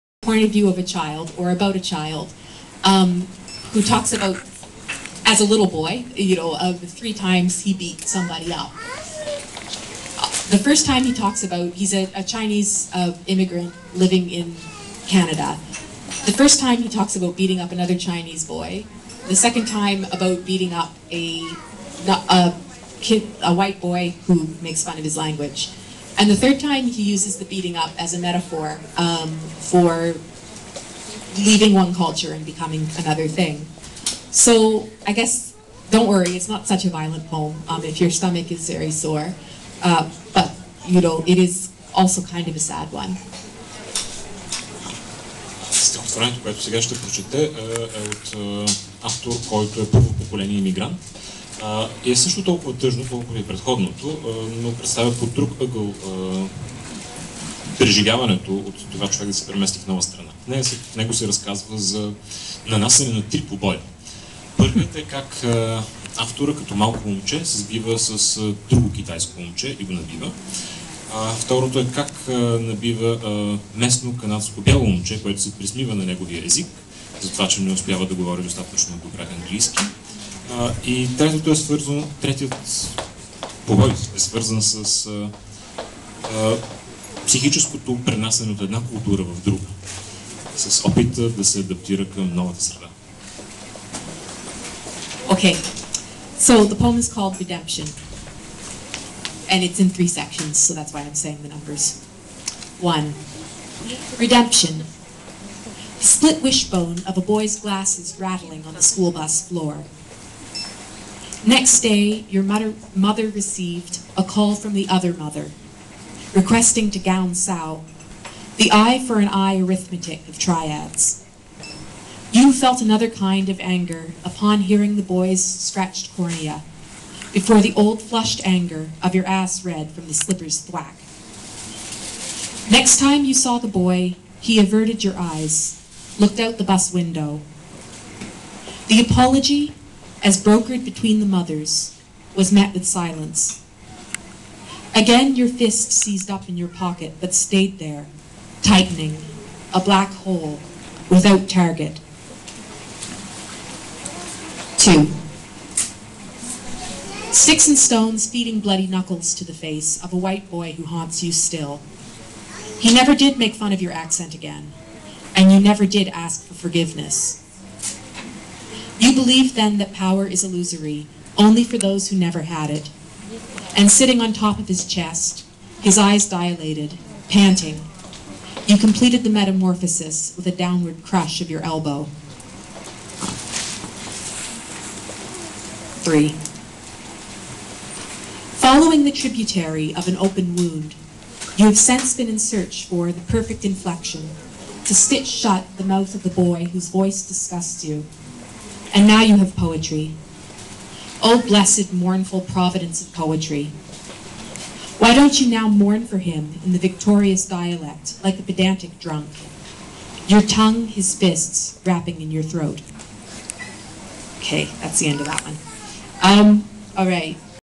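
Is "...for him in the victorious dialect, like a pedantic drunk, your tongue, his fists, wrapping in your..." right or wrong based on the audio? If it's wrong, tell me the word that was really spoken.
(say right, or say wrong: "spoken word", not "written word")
right.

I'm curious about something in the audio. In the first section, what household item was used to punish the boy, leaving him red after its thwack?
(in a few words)
The slipper.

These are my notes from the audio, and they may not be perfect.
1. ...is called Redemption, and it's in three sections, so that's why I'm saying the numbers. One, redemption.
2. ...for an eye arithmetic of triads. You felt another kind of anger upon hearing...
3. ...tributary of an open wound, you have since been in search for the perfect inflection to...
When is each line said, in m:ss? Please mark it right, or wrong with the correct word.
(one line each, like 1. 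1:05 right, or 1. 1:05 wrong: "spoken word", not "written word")
1. 1:37 right
2. 1:59 right
3. 3:09 right.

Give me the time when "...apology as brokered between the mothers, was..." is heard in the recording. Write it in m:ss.
2:19.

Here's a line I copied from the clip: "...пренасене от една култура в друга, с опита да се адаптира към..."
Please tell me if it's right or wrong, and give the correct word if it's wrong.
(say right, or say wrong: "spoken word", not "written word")
right.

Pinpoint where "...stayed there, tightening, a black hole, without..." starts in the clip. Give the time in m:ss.
2:27.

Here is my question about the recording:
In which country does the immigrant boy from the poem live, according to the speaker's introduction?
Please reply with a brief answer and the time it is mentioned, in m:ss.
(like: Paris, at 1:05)
Canada, at 0:15.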